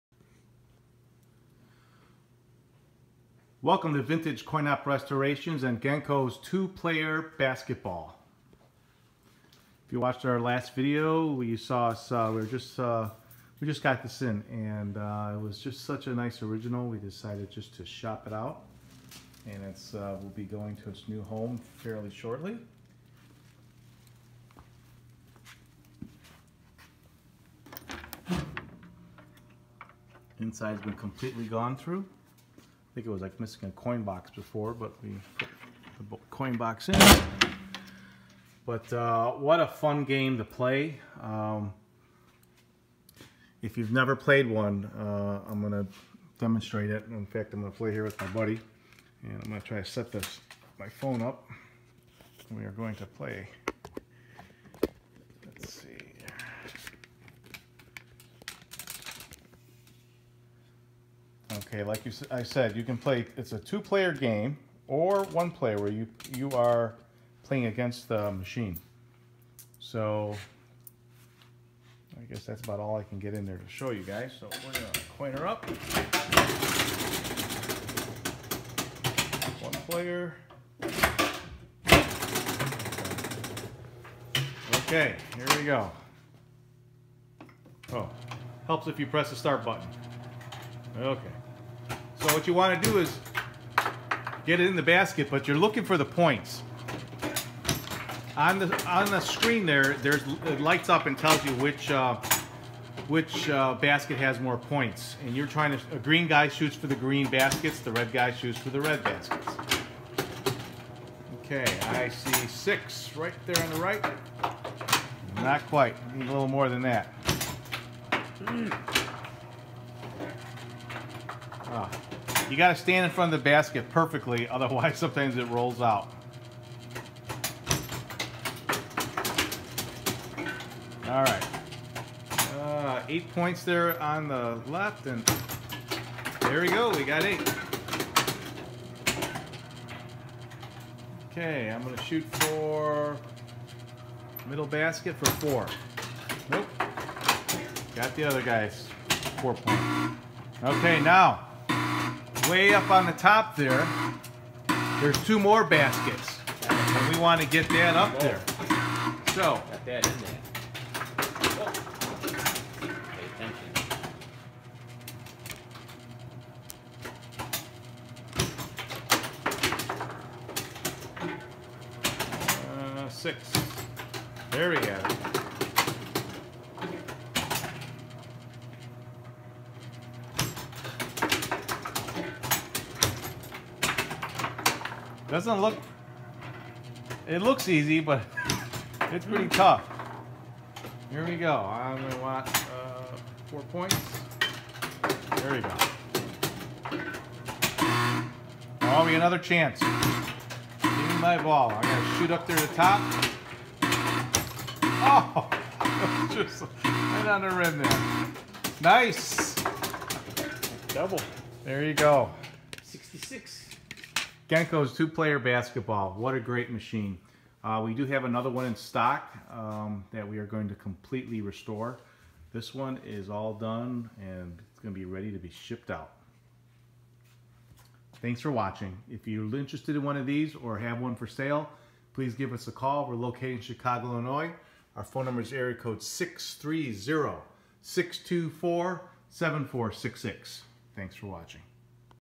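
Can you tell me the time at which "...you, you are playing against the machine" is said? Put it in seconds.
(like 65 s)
65 s.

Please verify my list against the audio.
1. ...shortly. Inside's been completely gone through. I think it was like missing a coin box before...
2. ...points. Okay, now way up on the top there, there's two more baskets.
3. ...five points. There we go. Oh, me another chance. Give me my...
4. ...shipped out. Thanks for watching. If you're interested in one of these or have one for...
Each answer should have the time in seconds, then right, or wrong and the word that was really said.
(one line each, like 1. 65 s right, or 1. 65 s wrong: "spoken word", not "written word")
1. 22 s right
2. 149 s right
3. 193 s wrong: "four", not "five"
4. 225 s right.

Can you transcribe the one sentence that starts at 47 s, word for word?
In fact, I'm going to play here with my buddy.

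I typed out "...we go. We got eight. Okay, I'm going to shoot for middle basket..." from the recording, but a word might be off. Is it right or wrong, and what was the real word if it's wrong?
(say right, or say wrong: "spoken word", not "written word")
right.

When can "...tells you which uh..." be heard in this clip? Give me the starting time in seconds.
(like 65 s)
101 s.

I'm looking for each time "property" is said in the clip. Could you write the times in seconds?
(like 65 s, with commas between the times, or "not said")
not said.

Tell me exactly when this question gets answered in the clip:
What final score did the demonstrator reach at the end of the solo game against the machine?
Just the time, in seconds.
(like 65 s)
212 s.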